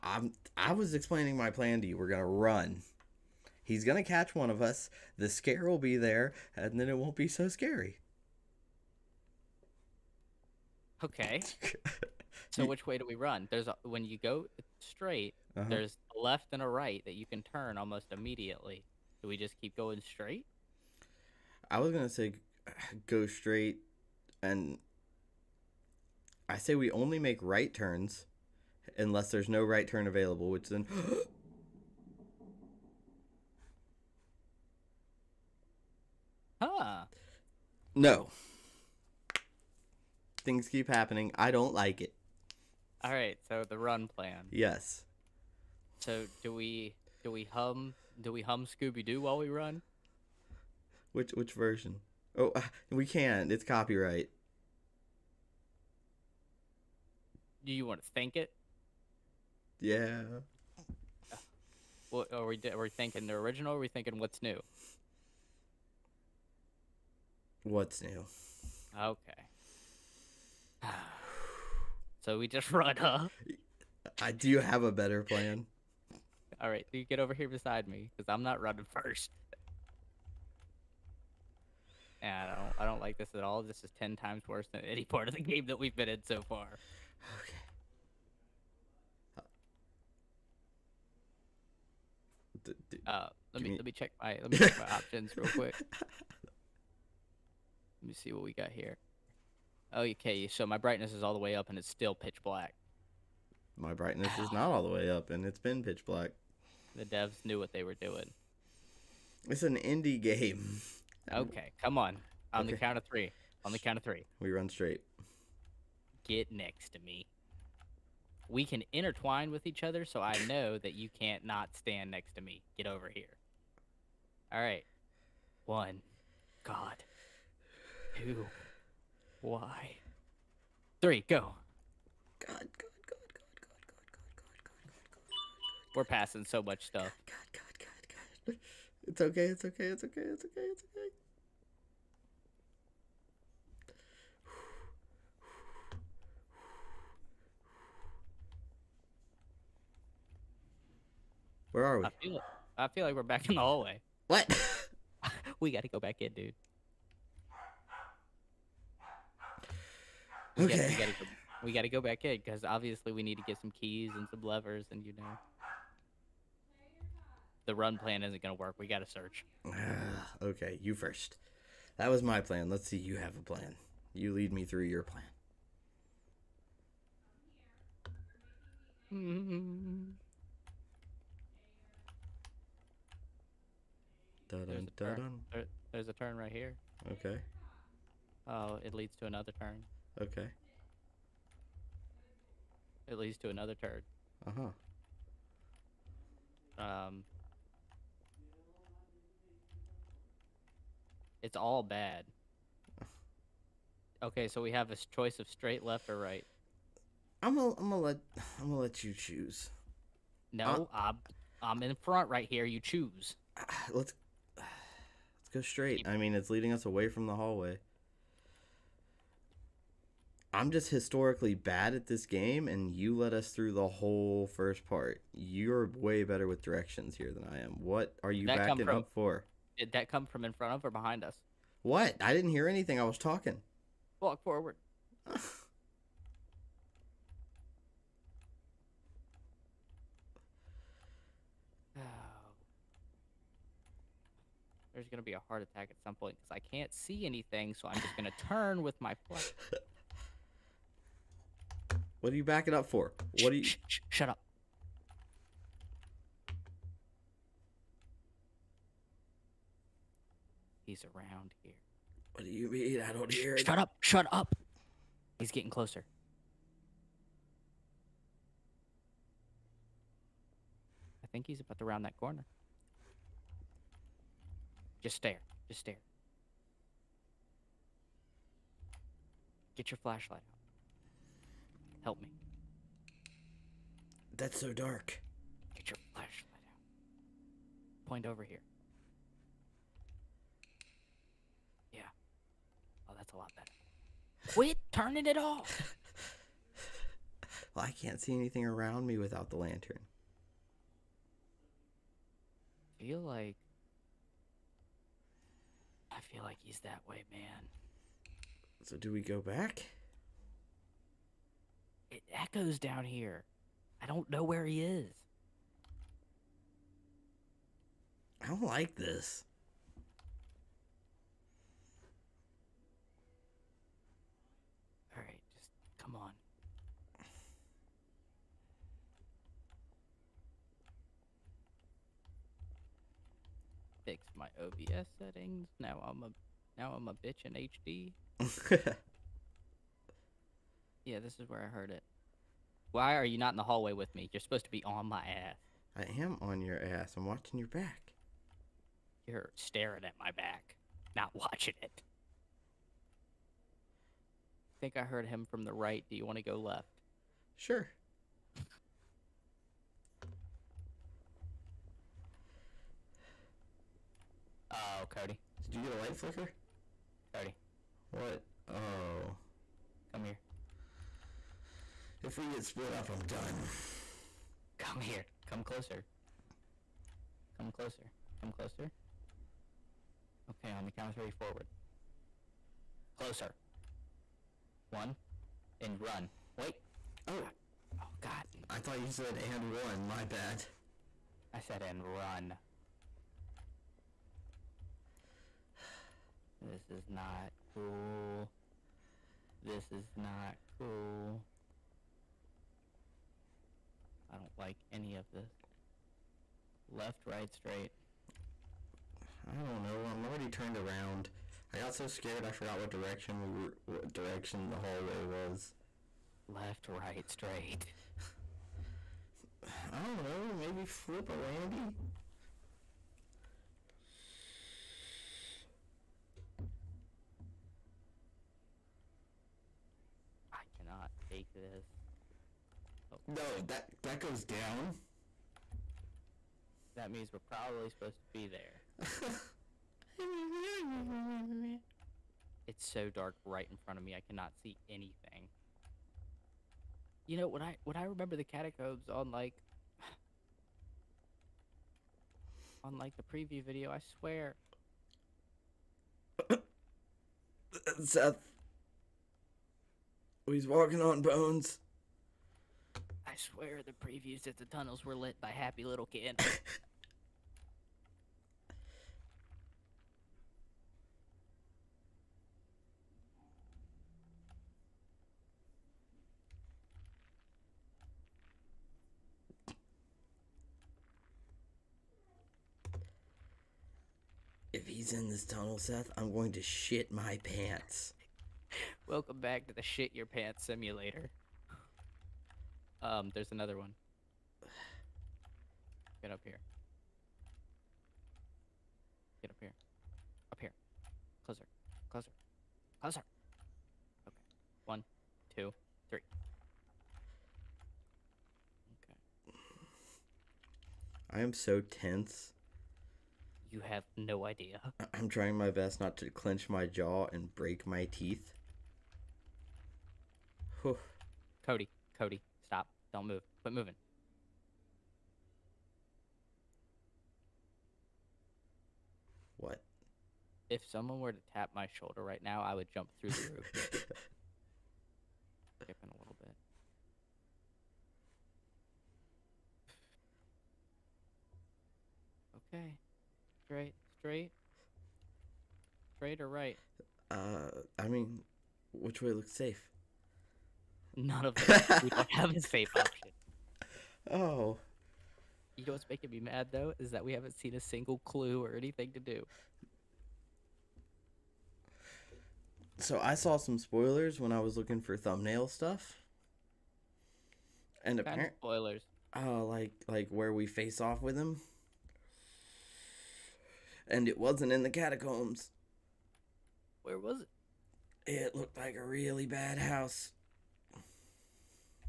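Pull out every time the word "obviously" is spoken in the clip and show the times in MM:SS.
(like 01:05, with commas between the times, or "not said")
02:42.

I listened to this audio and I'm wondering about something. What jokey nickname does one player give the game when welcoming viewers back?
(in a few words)
shit your pants simulator.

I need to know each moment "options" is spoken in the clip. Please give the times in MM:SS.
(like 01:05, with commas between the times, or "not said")
01:34, 09:12.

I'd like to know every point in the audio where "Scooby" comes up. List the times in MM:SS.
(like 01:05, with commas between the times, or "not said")
00:48.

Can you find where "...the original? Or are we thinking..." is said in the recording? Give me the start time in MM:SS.
01:03.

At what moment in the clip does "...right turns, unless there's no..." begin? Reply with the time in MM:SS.
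00:27.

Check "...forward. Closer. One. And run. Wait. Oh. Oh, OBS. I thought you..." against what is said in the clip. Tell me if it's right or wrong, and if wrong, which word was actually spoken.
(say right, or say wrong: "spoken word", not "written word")
wrong: "God", not "OBS".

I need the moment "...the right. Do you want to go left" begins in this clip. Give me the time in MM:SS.
05:55.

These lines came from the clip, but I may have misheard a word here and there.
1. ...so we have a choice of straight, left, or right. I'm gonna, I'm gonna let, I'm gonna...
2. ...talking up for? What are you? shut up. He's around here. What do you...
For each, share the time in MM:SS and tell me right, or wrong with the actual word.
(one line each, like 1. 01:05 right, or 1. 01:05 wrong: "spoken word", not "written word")
1. 03:24 right
2. 04:12 wrong: "backing", not "talking".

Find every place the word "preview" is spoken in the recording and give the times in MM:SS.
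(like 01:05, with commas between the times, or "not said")
07:33, 07:44.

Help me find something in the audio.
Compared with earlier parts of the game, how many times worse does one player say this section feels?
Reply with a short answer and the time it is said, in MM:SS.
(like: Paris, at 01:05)
10, at 01:23.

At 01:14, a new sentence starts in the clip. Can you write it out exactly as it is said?
I do have a better plan.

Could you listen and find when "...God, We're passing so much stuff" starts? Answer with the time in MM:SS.
02:15.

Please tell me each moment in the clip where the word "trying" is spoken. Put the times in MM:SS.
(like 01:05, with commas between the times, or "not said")
08:35.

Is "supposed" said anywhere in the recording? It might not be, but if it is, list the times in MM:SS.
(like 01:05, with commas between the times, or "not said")
05:44, 07:17.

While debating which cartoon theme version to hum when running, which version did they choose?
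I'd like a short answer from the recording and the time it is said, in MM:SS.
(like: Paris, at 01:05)
What's new, at 01:07.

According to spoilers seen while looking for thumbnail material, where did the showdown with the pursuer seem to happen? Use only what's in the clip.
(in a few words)
a really bad house.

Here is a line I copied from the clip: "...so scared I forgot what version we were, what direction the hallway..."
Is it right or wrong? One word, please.
wrong.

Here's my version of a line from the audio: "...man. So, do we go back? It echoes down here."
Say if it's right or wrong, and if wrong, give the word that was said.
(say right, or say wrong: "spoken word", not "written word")
right.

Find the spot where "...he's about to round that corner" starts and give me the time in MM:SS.
04:31.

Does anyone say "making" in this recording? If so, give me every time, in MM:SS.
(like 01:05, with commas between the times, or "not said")
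09:16.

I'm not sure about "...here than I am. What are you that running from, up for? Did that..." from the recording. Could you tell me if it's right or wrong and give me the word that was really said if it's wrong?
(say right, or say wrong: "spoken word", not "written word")
wrong: "backing", not "running".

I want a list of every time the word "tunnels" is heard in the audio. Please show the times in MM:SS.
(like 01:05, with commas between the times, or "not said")
07:44, 08:05.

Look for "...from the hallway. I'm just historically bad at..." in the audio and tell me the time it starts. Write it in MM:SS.
03:37.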